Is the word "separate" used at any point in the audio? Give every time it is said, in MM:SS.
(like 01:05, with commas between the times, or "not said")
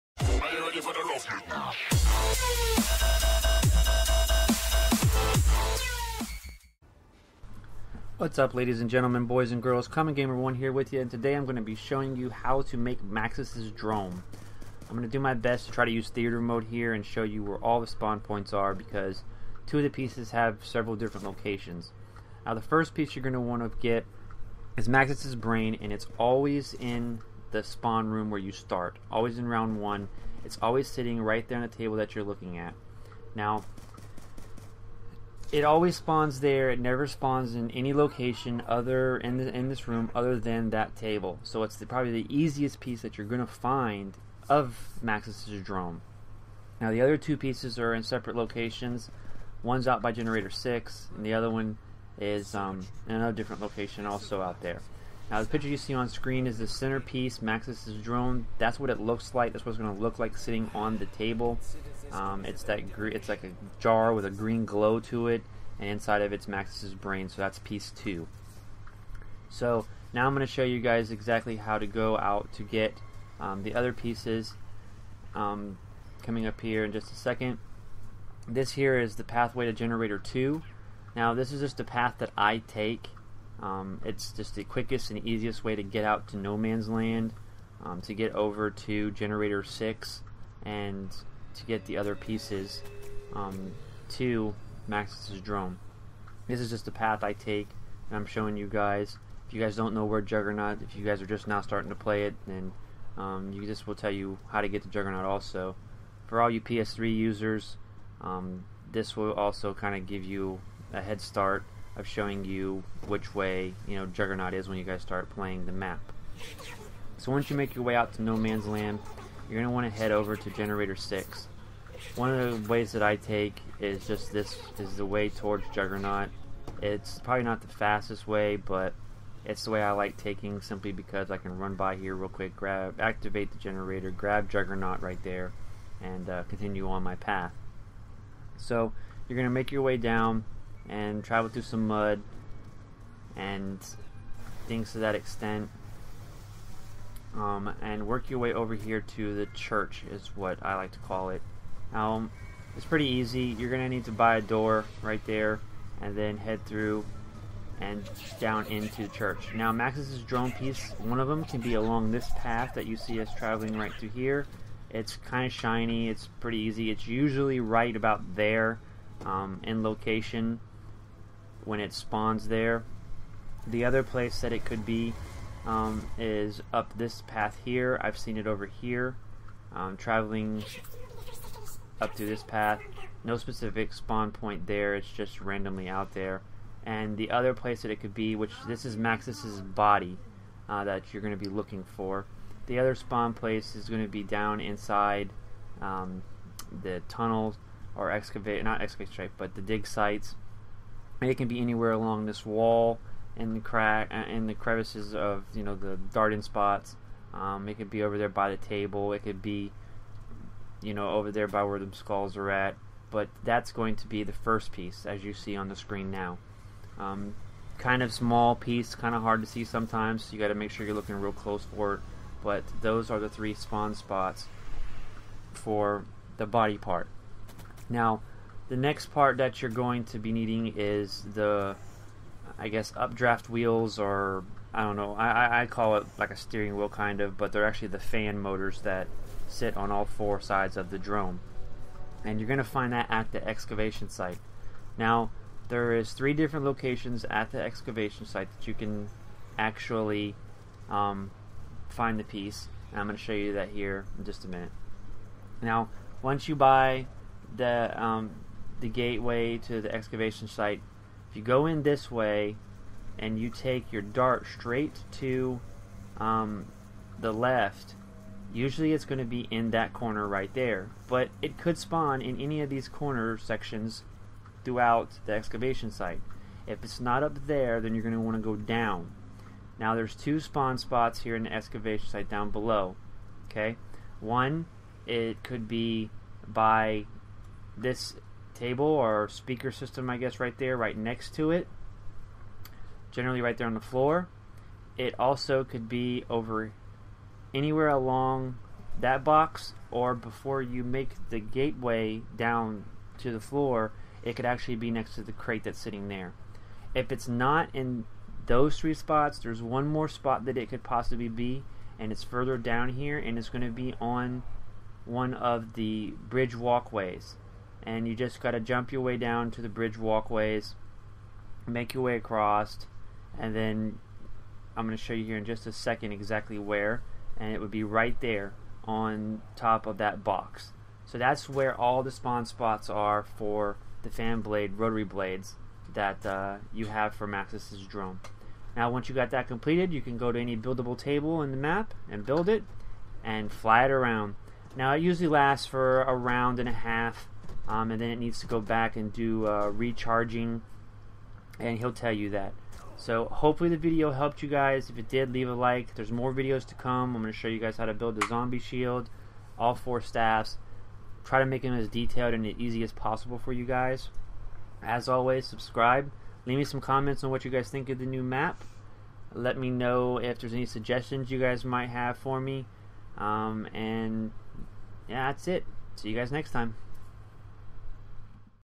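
00:48.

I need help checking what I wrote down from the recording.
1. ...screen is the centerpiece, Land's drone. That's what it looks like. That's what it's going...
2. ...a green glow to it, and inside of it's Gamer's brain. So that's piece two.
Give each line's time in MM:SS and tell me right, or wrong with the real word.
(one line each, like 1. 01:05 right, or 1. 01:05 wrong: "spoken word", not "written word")
1. 00:56 wrong: "Maxis", not "Land"
2. 01:04 wrong: "Maxis", not "Gamer".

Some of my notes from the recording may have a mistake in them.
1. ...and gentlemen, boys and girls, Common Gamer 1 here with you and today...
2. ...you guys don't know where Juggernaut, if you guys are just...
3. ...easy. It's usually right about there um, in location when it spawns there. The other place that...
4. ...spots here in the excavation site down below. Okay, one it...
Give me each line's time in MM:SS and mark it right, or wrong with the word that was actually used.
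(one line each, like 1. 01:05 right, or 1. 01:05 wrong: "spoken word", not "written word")
1. 00:08 right
2. 01:39 right
3. 02:46 right
4. 04:40 right.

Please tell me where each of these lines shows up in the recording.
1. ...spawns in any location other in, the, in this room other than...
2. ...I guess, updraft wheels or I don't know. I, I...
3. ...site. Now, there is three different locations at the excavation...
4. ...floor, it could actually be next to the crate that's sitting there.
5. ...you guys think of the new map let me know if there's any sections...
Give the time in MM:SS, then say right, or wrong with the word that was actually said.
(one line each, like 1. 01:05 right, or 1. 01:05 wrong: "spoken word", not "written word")
1. 00:37 right
2. 03:52 right
3. 04:04 right
4. 05:03 right
5. 06:07 wrong: "suggestions", not "sections".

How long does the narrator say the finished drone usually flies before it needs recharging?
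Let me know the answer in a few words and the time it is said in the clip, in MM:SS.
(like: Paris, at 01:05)
A round and a half, at 05:46.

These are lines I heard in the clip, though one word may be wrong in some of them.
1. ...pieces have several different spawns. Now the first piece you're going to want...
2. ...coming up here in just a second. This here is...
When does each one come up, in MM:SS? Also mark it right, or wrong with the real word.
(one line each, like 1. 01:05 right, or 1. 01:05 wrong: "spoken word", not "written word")
1. 00:19 wrong: "locations", not "spawns"
2. 01:16 right.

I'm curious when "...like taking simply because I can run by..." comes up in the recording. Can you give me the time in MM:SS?
02:09.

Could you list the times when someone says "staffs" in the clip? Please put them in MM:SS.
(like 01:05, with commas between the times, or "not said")
06:00.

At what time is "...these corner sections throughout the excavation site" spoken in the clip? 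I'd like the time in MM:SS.
04:32.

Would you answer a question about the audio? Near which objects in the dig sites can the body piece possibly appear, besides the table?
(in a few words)
The skulls.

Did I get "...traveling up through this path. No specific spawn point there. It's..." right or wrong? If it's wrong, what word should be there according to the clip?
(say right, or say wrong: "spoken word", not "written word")
right.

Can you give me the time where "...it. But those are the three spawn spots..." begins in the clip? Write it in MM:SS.
03:41.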